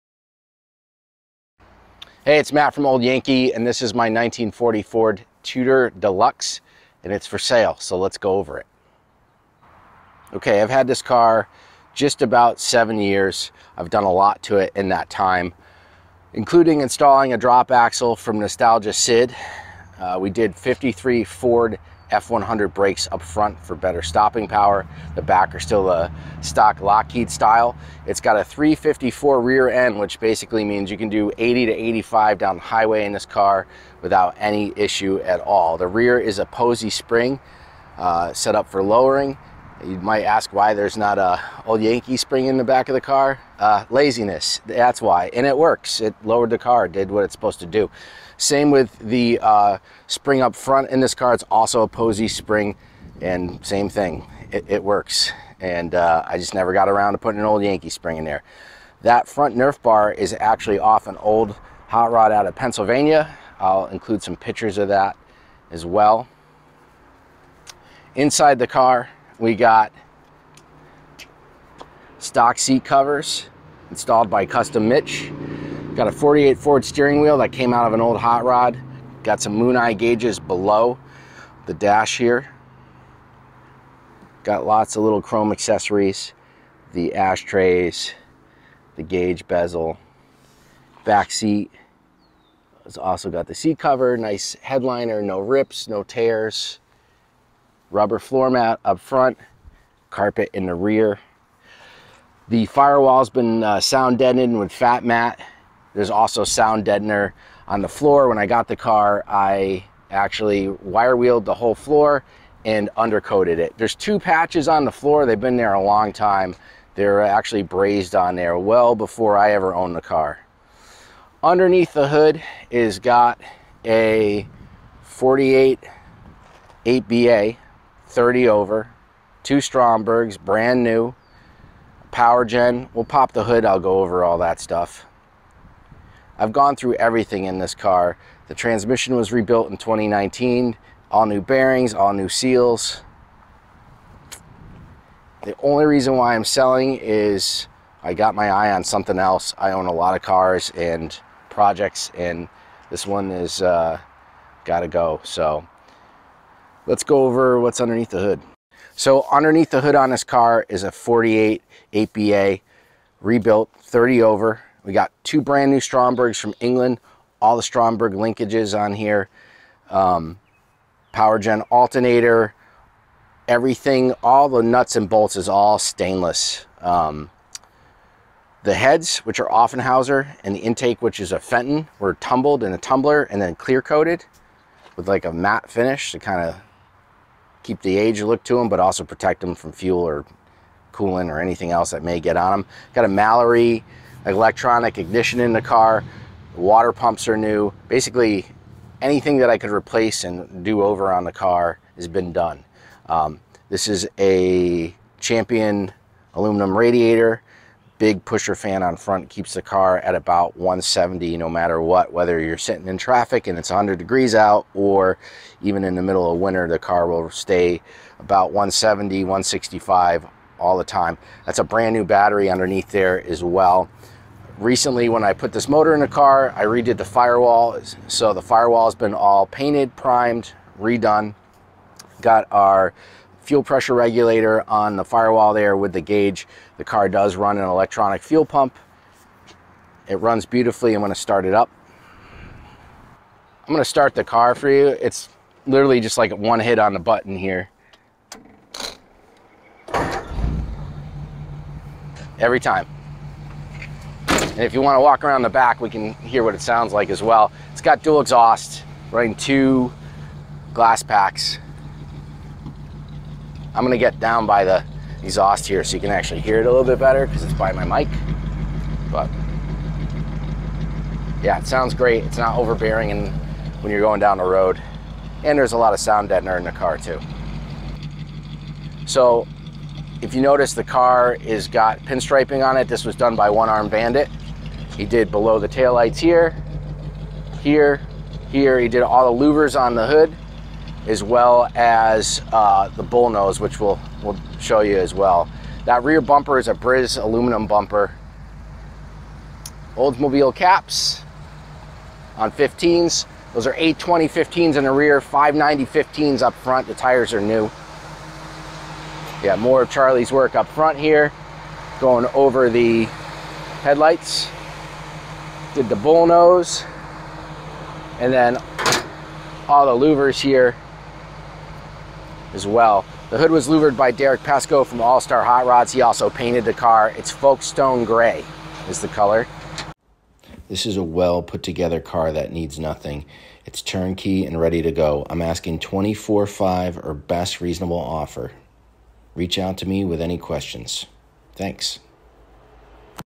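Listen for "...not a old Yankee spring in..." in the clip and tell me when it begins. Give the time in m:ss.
0:40.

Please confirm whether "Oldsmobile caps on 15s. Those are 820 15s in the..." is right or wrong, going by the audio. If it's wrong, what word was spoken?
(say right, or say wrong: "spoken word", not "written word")
right.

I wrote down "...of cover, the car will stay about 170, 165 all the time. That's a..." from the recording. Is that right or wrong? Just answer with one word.
wrong.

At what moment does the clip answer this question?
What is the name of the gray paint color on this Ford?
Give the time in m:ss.
5:27.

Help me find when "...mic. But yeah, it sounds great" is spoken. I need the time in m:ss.
4:27.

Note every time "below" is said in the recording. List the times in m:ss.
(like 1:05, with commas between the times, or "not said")
1:20, 4:45.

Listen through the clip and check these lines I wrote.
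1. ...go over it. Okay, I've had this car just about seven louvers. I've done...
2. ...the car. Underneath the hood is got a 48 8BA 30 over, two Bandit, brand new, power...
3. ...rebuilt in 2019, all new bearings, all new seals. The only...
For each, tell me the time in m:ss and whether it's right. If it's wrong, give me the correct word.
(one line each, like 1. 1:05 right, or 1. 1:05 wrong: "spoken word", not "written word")
1. 0:08 wrong: "years", not "louvers"
2. 1:59 wrong: "Strombergs", not "Bandit"
3. 2:19 right.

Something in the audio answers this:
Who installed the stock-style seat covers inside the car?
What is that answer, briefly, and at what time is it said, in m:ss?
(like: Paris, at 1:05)
Custom Mitch, at 1:14.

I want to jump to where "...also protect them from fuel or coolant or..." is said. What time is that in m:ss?
3:08.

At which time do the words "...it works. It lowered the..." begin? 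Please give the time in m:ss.
0:45.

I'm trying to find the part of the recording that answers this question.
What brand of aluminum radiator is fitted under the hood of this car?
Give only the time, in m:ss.
3:25.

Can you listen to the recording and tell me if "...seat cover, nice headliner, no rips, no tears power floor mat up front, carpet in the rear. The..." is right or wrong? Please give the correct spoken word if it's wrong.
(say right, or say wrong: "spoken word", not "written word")
wrong: "rubber", not "power".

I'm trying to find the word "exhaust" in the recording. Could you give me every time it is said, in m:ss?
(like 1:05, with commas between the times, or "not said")
4:18, 4:25.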